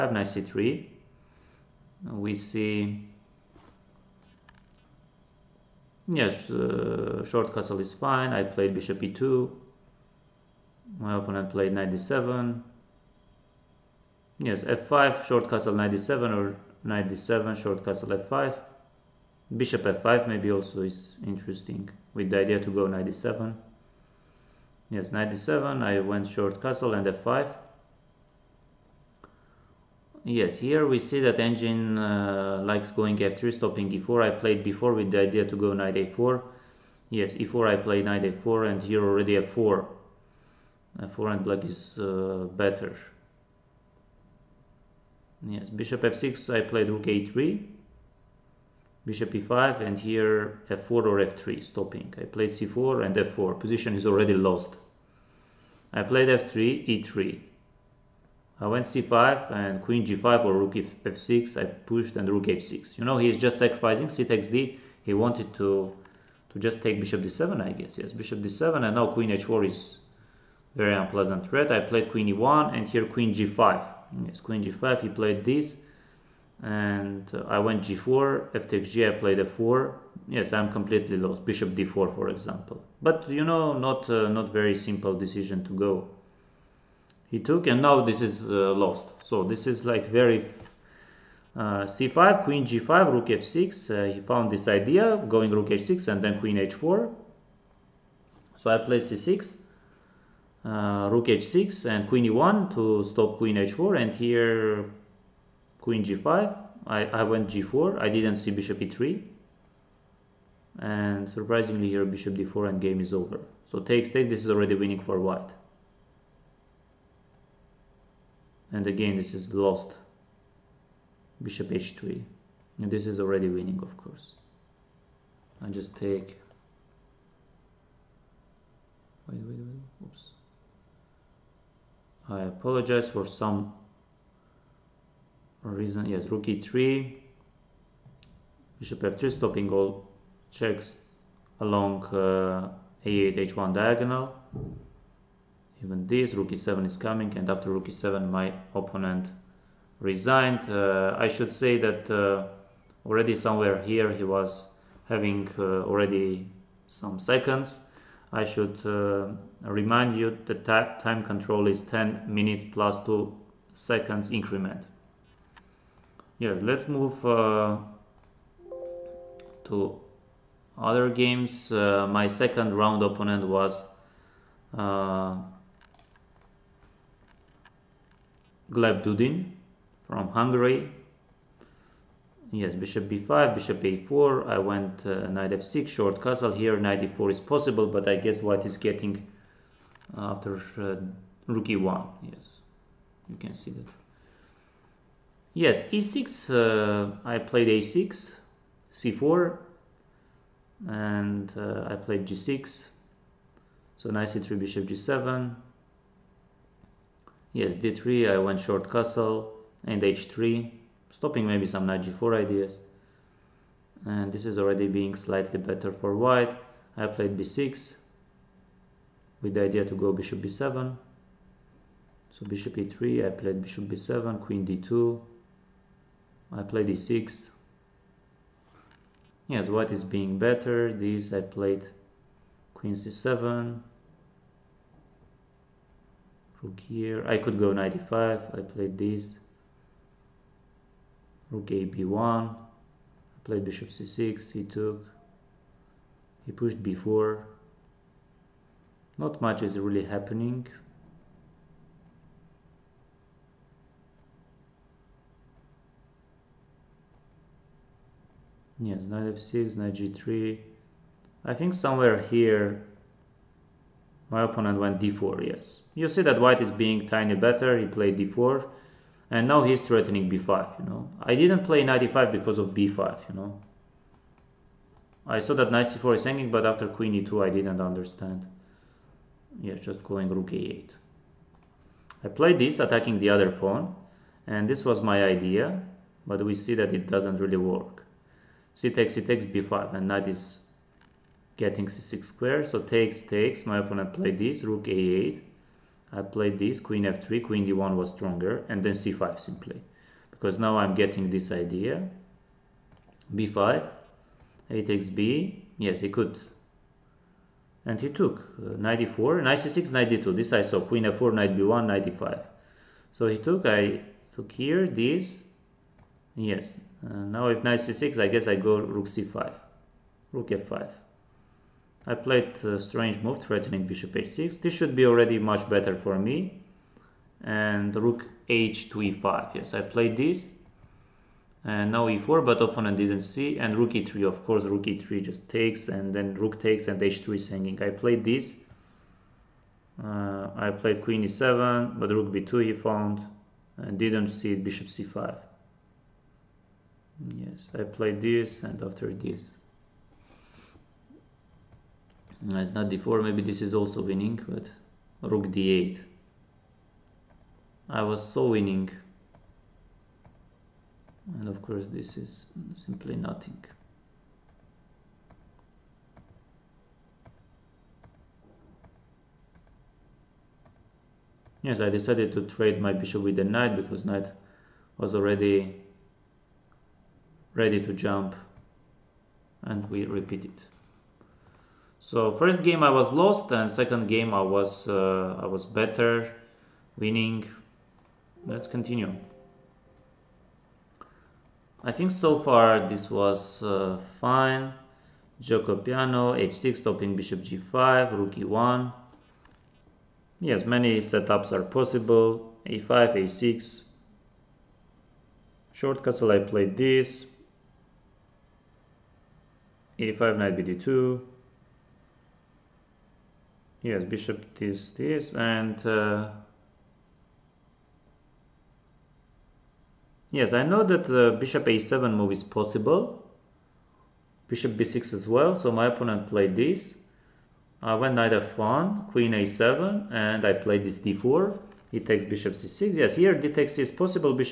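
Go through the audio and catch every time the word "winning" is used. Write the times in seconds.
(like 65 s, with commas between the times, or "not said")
114 s, 123 s, 354 s, 358 s, 386 s.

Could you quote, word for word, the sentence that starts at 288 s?
c takes, c takes b5, and knight is getting c6 square.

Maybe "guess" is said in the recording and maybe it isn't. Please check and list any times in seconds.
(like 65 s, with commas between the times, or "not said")
67 s, 188 s, 318 s.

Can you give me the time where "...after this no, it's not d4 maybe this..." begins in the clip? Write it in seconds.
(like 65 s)
348 s.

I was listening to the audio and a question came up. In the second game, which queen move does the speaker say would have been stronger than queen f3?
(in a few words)
queen d1.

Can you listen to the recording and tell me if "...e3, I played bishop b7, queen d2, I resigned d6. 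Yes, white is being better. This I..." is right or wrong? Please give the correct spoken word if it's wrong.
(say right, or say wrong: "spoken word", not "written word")
wrong: "played", not "resigned".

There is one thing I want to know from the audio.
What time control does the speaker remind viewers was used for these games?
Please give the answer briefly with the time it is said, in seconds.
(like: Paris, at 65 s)
10 minutes plus 2 seconds, at 161 s.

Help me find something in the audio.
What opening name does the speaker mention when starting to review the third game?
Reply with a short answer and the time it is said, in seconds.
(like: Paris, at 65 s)
Giuoco Piano, at 395 s.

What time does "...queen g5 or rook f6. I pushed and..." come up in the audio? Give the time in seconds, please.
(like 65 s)
59 s.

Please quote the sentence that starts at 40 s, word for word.
f4 and black is uh, better.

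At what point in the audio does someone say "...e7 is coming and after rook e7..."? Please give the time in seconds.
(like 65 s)
146 s.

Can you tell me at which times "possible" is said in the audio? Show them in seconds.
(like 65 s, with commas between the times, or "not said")
187 s, 401 s, 422 s, 433 s.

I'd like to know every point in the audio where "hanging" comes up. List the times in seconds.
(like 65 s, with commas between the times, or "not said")
276 s, 337 s.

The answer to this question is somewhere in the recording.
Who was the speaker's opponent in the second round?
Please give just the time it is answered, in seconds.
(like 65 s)
178 s.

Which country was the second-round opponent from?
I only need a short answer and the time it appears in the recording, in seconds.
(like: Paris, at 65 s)
Hungary, at 180 s.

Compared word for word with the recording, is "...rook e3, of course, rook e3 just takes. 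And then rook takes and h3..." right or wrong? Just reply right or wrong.
right.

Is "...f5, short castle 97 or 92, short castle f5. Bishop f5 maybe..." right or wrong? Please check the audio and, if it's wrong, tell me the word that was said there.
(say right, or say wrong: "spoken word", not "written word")
wrong: "97", not "92".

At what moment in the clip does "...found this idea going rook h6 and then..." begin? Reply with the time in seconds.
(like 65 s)
94 s.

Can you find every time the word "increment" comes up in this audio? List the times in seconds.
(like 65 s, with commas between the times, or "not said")
164 s.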